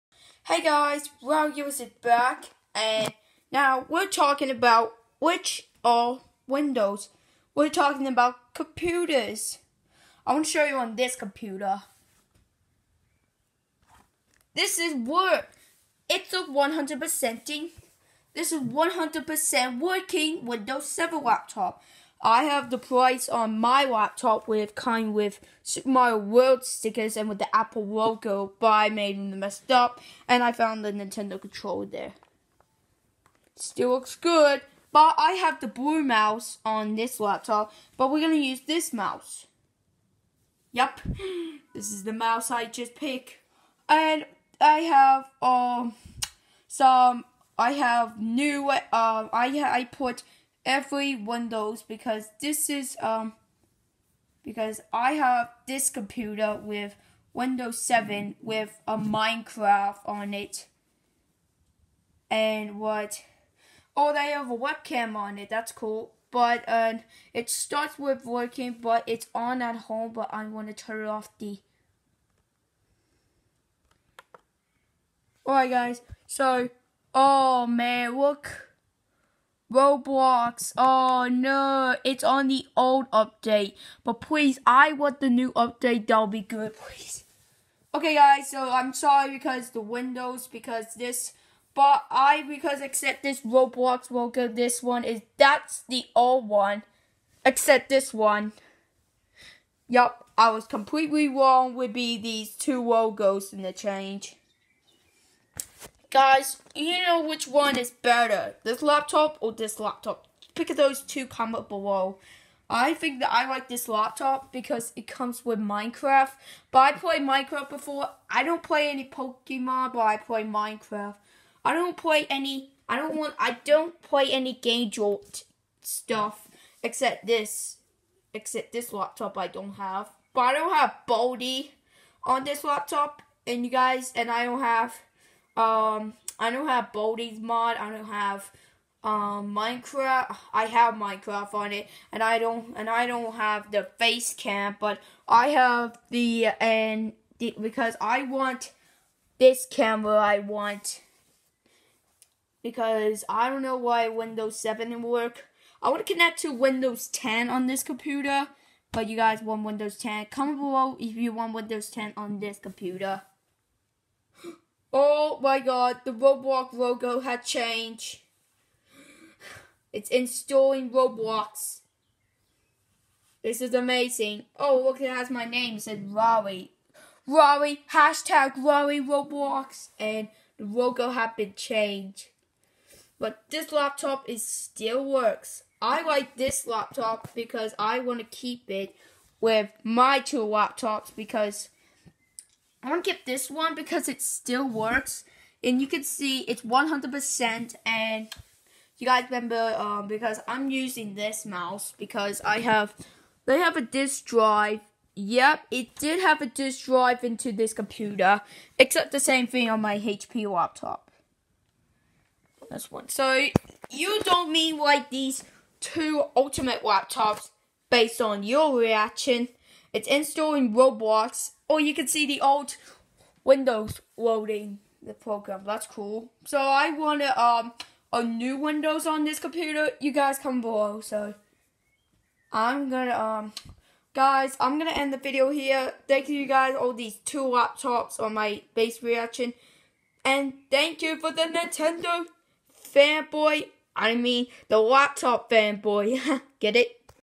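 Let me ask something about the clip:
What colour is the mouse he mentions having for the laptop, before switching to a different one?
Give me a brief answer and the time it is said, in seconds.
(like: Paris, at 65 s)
Blue, at 35 s.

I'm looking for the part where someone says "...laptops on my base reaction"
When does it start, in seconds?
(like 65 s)
237 s.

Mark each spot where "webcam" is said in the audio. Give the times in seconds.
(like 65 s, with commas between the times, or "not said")
64 s.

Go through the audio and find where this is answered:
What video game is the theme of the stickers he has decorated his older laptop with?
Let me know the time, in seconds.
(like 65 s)
25 s.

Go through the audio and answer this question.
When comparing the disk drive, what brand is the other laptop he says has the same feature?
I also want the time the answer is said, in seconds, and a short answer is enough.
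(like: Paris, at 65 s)
HP, at 209 s.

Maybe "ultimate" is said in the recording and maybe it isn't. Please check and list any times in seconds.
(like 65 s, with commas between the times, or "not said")
216 s.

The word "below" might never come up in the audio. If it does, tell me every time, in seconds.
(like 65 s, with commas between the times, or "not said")
111 s, 160 s, 230 s.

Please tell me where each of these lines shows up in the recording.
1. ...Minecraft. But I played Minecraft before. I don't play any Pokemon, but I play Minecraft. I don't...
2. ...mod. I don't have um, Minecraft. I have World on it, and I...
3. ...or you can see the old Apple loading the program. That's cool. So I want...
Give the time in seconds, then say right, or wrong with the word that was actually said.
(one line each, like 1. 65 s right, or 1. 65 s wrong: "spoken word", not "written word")
1. 115 s right
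2. 137 s wrong: "Minecraft", not "World"
3. 221 s wrong: "Windows", not "Apple".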